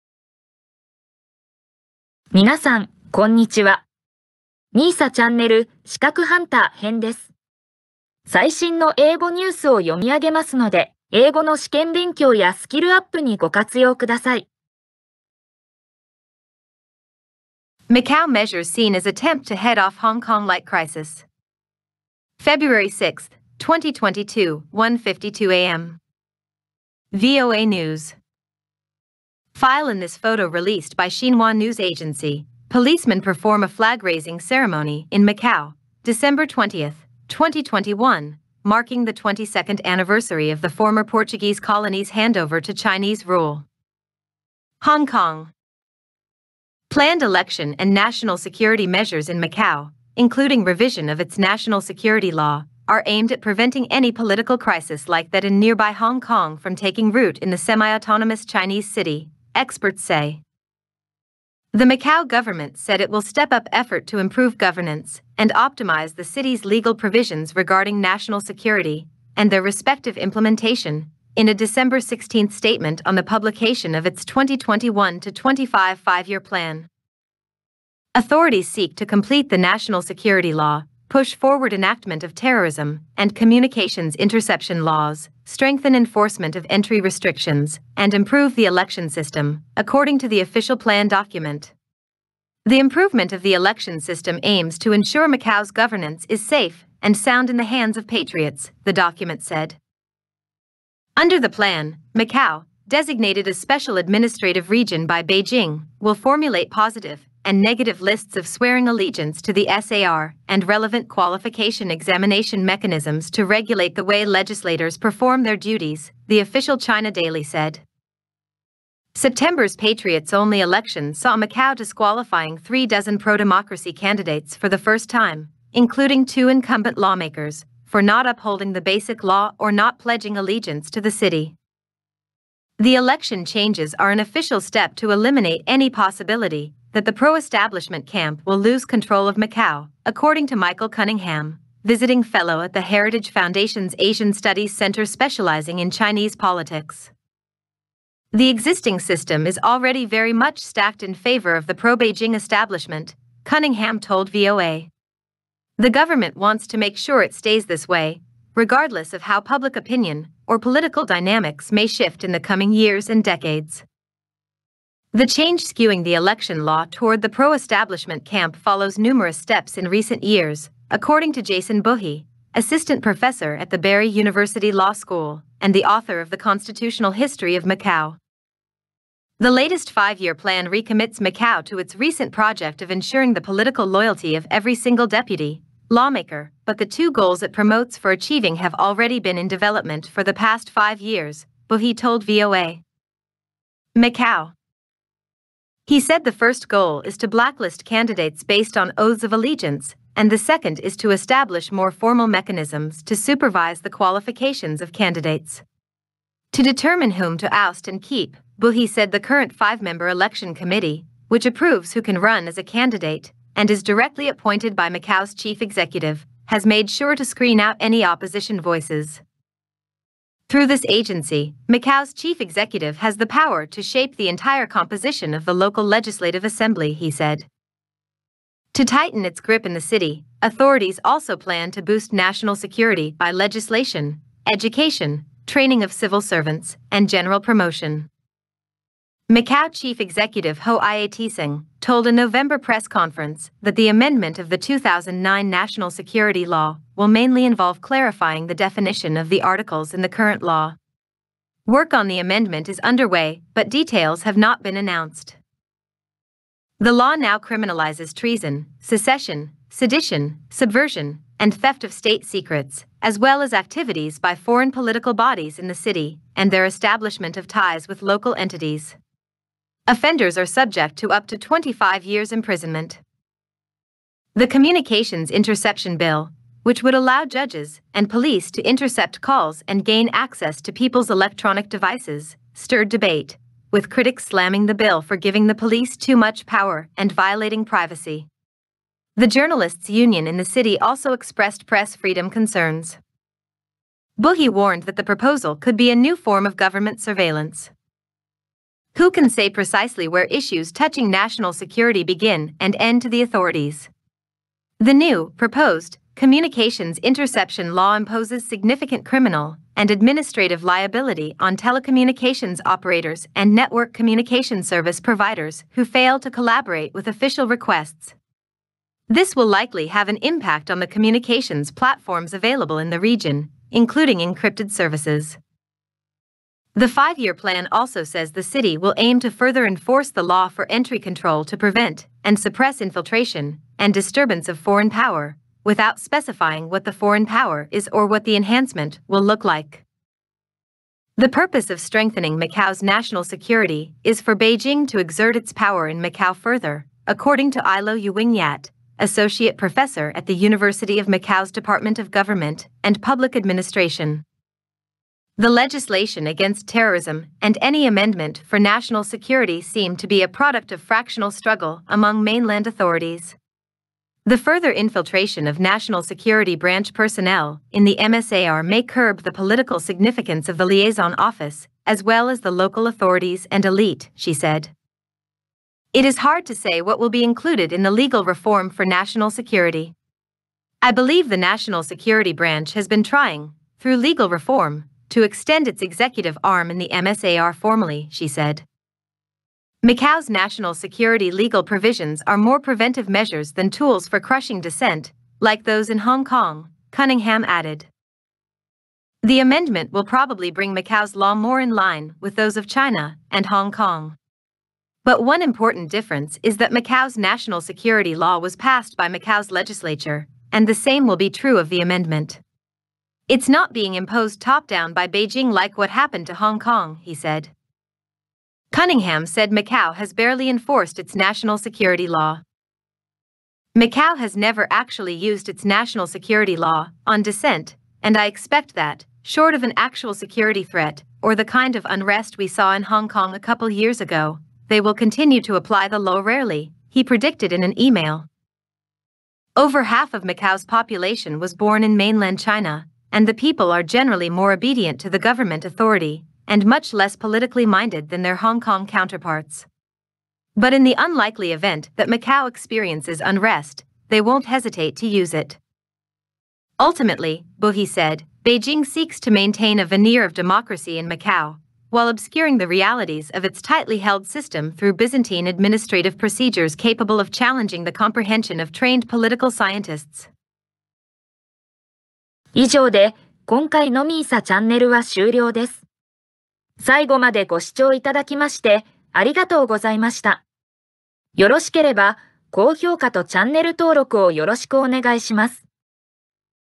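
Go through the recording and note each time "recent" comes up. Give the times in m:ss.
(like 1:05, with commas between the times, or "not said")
2:49, 3:01.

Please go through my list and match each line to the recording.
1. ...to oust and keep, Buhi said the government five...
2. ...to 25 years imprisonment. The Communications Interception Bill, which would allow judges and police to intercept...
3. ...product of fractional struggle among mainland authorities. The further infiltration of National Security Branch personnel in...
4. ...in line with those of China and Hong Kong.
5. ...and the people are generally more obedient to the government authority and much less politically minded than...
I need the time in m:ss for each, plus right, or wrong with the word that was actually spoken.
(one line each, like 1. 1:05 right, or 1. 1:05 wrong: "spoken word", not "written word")
1. 3:27 wrong: "current", not "government"
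2. 4:31 right
3. 6:00 right
4. 6:41 right
5. 7:23 right.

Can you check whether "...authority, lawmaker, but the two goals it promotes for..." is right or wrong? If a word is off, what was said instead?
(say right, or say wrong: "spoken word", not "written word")
wrong: "deputy", not "authority".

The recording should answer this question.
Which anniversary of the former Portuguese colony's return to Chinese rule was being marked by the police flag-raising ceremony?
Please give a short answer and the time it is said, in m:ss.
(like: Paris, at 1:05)
22nd, at 0:39.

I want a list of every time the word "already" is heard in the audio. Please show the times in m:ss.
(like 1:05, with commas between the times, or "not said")
2:29, 3:08.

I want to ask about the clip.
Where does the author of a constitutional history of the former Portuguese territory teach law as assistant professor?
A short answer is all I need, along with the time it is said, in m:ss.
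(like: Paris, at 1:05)
Barry University, at 2:53.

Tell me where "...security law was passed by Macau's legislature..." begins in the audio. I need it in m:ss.
6:47.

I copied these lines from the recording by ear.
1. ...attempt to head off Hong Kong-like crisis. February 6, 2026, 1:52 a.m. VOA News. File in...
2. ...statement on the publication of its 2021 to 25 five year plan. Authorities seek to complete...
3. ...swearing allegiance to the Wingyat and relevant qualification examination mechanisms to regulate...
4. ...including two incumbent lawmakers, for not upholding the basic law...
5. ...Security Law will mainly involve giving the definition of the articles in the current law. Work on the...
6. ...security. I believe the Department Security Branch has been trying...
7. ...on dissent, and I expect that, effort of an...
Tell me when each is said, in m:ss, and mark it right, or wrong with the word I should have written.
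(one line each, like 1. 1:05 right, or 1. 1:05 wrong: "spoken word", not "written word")
1. 0:19 wrong: "2022", not "2026"
2. 1:12 right
3. 1:48 wrong: "SAR", not "Wingyat"
4. 2:05 right
5. 4:05 wrong: "clarifying", not "giving"
6. 6:19 wrong: "National", not "Department"
7. 7:07 wrong: "short", not "effort".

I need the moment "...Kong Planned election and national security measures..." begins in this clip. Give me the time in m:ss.
0:45.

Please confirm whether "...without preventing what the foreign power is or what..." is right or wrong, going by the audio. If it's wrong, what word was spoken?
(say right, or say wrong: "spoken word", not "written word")
wrong: "specifying", not "preventing".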